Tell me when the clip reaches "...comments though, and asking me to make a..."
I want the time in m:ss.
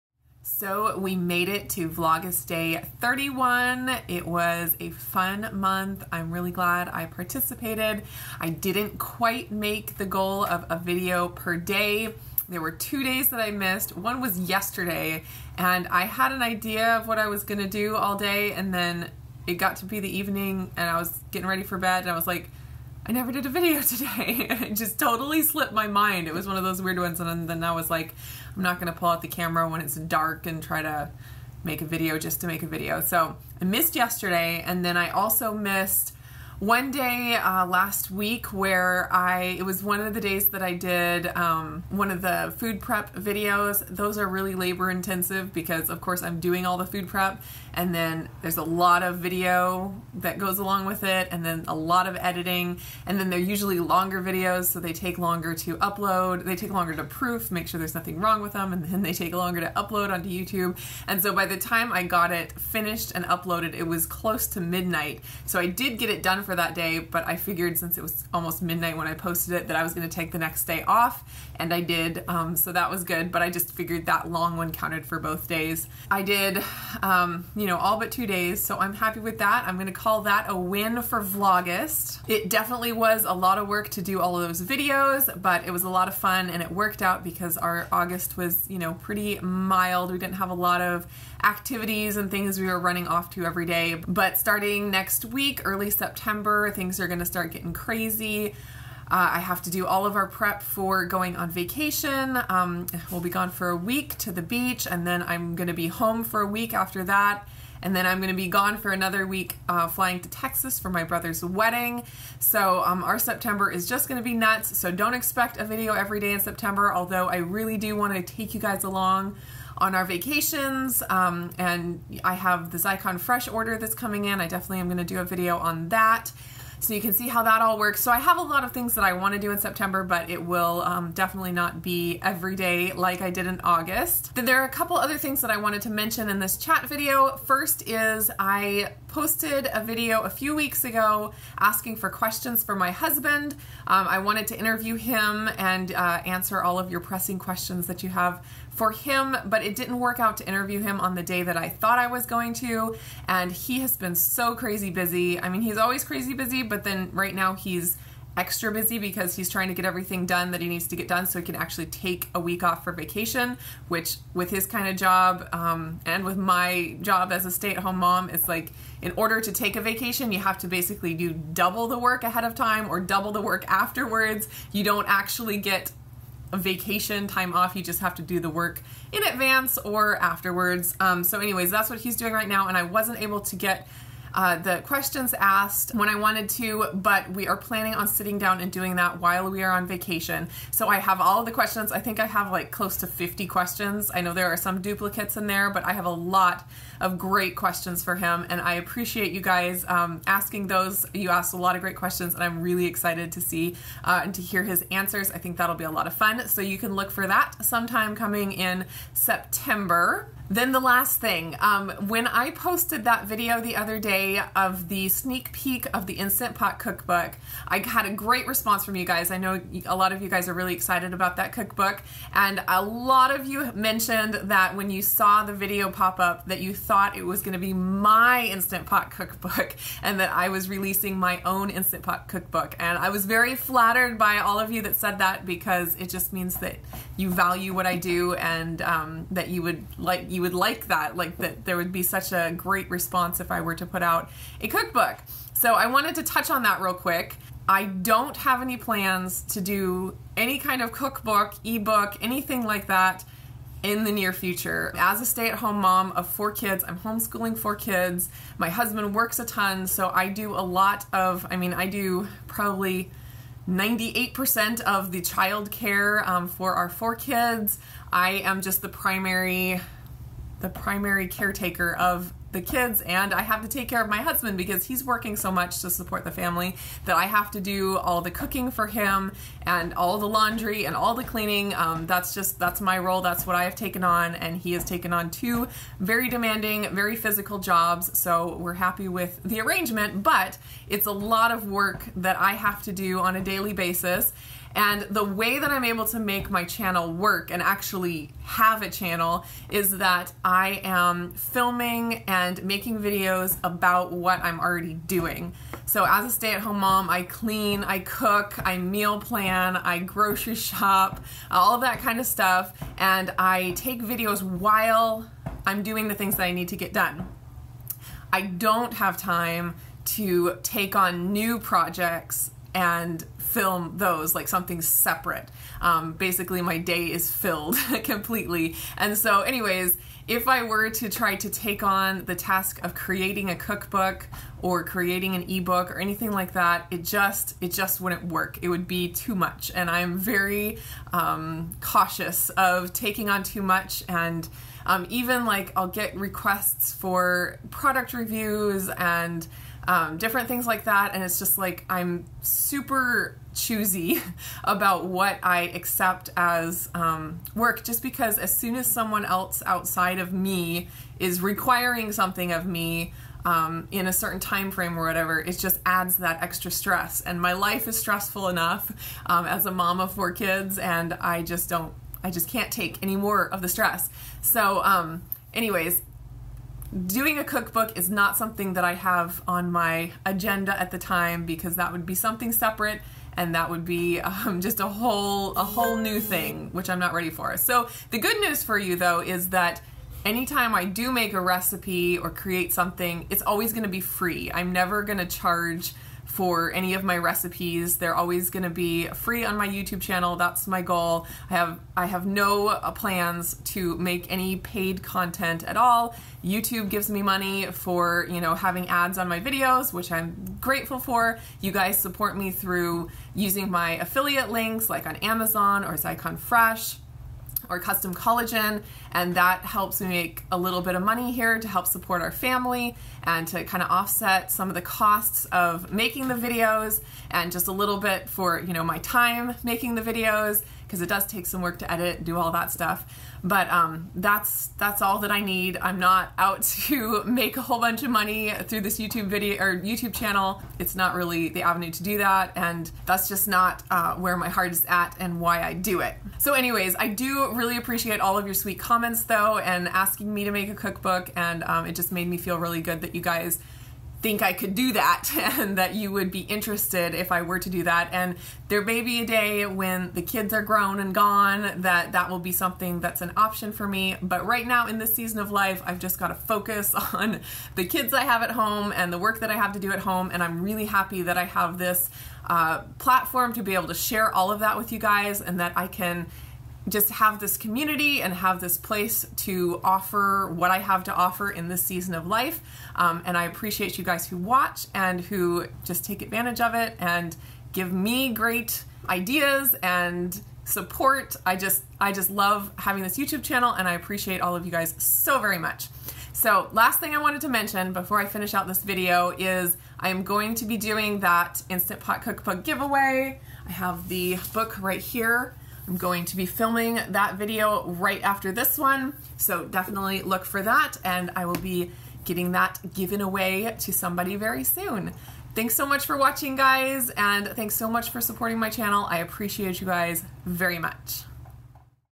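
7:28.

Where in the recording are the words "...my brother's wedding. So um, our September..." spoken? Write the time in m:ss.
1:50.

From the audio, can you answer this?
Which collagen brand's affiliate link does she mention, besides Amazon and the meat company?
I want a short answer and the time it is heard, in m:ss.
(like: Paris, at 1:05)
Custom Collagen, at 6:57.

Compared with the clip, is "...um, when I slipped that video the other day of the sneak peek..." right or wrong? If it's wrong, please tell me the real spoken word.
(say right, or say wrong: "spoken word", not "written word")
wrong: "posted", not "slipped".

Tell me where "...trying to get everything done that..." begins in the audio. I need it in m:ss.
2:39.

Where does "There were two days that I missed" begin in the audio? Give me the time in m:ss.
0:12.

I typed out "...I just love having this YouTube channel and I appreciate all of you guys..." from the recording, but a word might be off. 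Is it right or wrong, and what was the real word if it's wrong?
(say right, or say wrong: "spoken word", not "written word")
right.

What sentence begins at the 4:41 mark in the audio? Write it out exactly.
Um, that's just that's my role.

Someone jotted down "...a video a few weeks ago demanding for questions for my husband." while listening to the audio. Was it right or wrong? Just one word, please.
wrong.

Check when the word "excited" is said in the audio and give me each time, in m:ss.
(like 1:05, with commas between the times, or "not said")
3:22, 3:40.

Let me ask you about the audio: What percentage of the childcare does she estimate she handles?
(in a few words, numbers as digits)
98%.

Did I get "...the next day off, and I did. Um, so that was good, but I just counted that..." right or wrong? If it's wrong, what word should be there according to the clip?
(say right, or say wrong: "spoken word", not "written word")
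wrong: "figured", not "counted".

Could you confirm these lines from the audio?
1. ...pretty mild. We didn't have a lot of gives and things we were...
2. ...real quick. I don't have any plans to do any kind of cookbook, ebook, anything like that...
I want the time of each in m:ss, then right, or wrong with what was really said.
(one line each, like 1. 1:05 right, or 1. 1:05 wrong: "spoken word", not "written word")
1. 1:28 wrong: "activities", not "gives"
2. 4:06 right.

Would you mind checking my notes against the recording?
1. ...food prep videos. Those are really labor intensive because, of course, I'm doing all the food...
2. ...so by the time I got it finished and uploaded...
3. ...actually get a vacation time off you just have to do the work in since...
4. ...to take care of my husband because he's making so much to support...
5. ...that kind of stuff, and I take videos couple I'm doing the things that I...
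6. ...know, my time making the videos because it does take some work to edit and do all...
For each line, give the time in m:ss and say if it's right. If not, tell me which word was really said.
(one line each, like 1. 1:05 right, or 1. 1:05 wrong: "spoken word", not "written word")
1. 0:42 right
2. 1:01 right
3. 2:55 wrong: "advance", not "since"
4. 4:33 wrong: "working", not "making"
5. 5:11 wrong: "while", not "couple"
6. 7:08 right.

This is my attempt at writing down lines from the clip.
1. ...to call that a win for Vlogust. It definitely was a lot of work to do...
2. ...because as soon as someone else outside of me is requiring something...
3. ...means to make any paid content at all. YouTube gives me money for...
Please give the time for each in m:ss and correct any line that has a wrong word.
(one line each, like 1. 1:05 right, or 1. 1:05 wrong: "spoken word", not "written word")
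1. 1:19 right
2. 5:58 right
3. 6:42 wrong: "plans", not "means".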